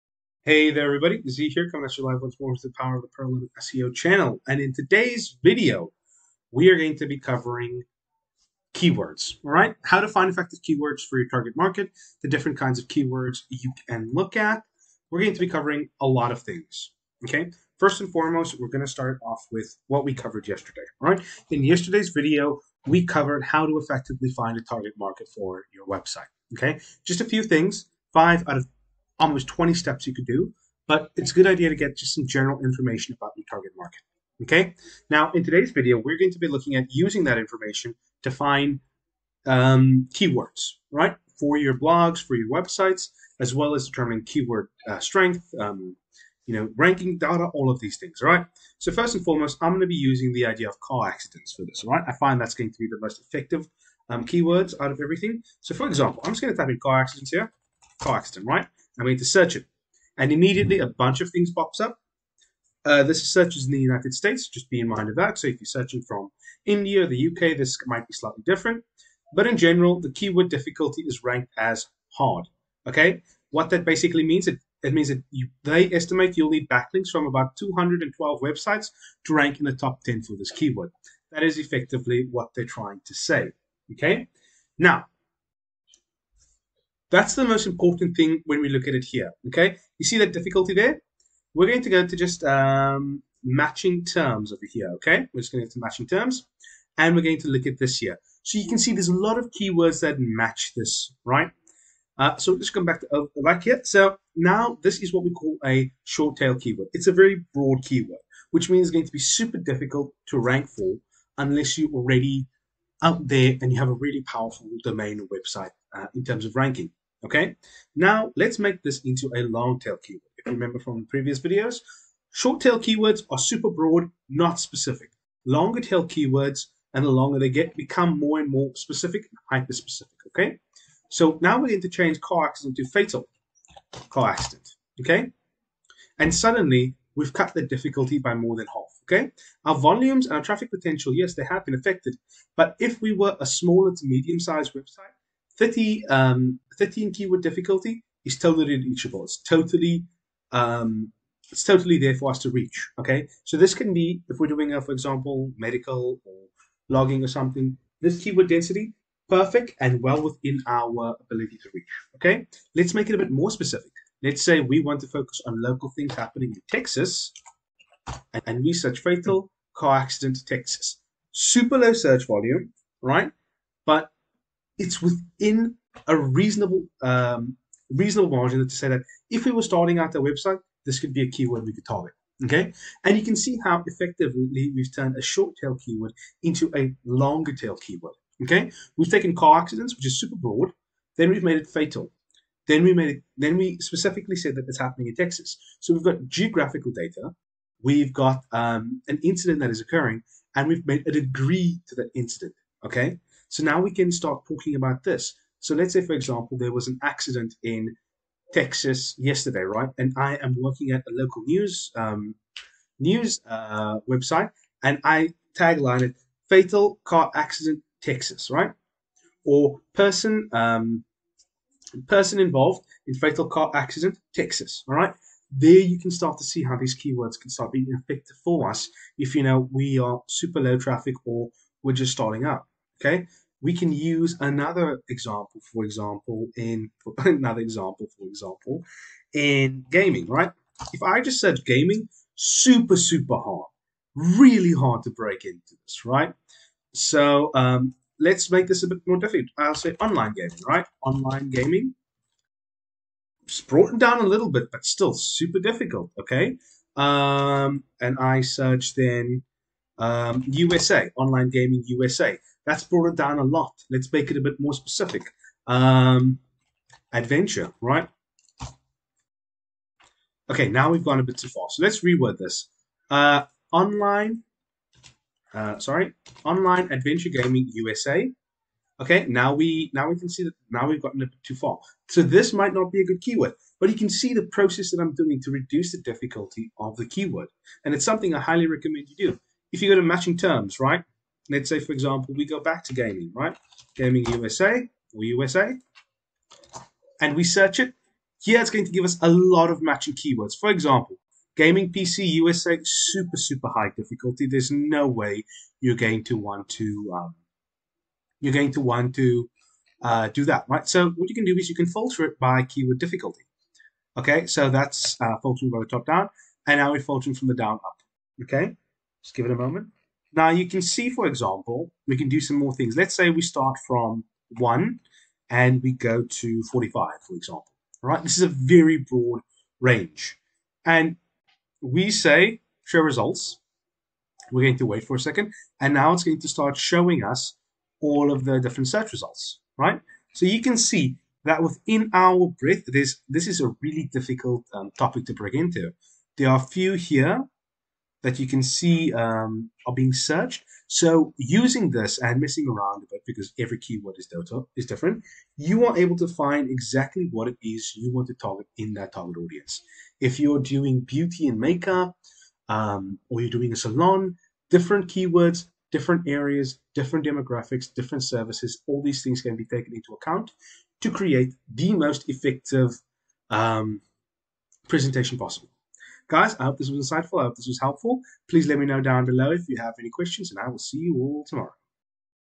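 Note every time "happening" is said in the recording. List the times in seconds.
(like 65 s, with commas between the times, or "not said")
166 s, 194 s.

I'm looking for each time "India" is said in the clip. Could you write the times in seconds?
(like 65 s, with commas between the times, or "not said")
66 s.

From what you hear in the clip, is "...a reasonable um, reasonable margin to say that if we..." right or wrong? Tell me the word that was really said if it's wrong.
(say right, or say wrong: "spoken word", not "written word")
right.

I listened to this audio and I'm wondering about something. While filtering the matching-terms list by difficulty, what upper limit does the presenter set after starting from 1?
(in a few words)
45.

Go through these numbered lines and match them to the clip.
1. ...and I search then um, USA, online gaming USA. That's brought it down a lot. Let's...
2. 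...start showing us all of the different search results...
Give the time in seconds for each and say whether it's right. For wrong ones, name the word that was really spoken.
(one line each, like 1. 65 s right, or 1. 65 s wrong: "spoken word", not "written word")
1. 258 s right
2. 336 s right.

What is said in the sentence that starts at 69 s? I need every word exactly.
But in general, the keyword difficulty is ranked as hard.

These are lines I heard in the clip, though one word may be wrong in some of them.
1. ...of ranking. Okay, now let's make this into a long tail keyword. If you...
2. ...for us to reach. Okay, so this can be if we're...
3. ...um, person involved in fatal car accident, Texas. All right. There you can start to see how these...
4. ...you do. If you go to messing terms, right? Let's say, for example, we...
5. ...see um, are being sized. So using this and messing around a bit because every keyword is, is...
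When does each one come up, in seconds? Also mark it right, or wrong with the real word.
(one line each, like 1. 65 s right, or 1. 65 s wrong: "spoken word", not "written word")
1. 116 s right
2. 152 s right
3. 220 s right
4. 289 s wrong: "matching", not "messing"
5. 348 s wrong: "searched", not "sized".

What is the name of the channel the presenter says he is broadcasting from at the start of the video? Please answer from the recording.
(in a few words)
Pearl Lemon SEO.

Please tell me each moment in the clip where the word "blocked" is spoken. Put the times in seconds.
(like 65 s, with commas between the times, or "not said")
not said.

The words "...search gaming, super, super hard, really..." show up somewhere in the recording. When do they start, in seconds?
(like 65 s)
241 s.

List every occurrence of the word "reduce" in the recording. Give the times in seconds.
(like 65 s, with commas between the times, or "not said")
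285 s.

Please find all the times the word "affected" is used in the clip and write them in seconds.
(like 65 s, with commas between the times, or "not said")
141 s.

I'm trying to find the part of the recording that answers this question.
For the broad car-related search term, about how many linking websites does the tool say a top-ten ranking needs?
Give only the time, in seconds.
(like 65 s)
77 s.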